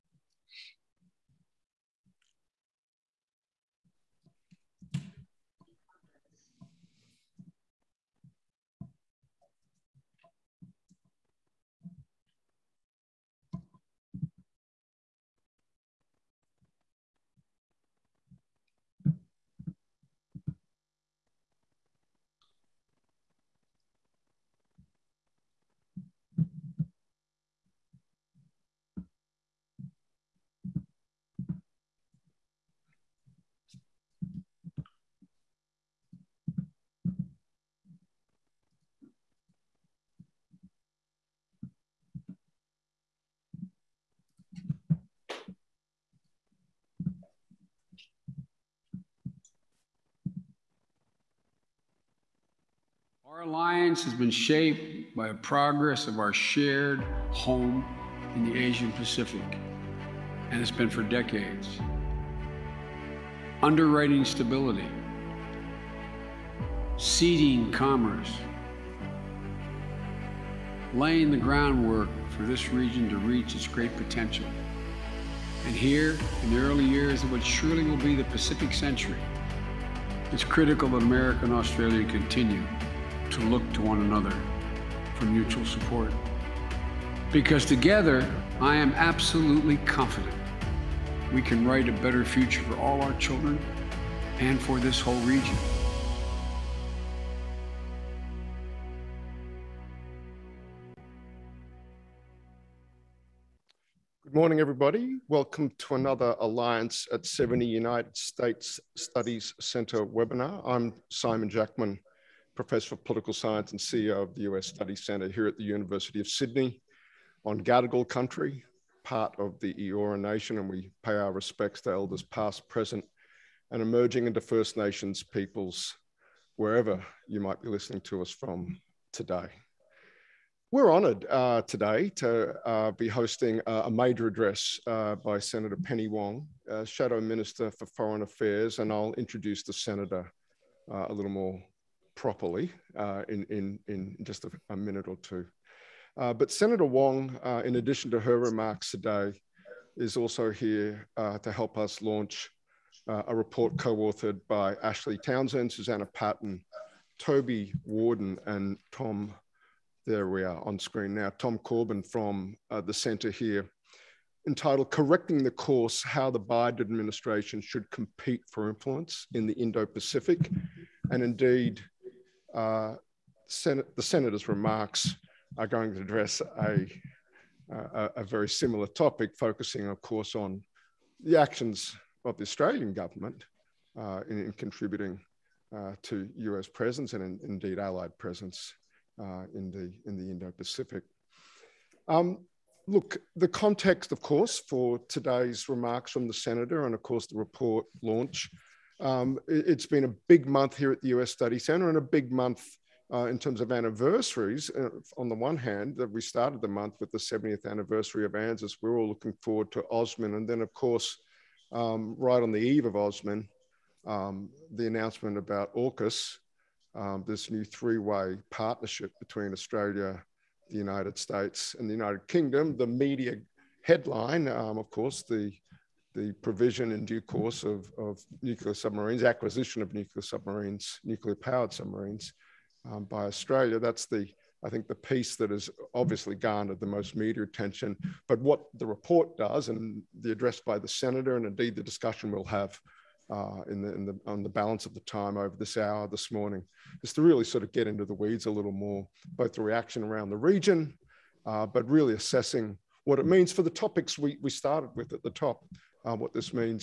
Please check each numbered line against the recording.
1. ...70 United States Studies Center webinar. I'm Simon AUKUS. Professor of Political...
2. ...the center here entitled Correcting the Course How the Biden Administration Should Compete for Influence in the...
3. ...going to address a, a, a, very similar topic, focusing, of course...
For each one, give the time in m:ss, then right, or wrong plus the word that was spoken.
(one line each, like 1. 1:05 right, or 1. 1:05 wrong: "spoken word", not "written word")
1. 1:47 wrong: "Jackman", not "AUKUS"
2. 2:42 right
3. 2:55 right.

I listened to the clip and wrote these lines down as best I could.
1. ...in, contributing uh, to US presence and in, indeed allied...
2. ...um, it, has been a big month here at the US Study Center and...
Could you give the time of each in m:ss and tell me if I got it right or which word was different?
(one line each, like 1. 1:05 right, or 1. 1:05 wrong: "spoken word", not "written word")
1. 3:04 right
2. 3:19 right.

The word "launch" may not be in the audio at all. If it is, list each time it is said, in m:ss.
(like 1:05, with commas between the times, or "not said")
2:32, 3:18.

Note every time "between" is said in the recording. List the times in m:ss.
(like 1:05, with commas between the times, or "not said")
3:39.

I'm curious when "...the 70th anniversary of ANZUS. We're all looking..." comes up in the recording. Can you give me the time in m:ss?
3:27.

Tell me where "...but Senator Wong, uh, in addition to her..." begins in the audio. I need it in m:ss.
2:26.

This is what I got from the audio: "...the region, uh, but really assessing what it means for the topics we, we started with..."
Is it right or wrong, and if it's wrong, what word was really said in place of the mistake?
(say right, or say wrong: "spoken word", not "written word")
right.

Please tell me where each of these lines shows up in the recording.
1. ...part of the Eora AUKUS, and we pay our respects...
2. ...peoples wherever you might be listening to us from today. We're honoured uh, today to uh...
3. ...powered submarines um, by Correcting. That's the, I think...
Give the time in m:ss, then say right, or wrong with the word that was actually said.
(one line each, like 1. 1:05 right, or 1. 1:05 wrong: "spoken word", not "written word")
1. 1:59 wrong: "Nation", not "AUKUS"
2. 2:05 right
3. 3:51 wrong: "Australia", not "Correcting".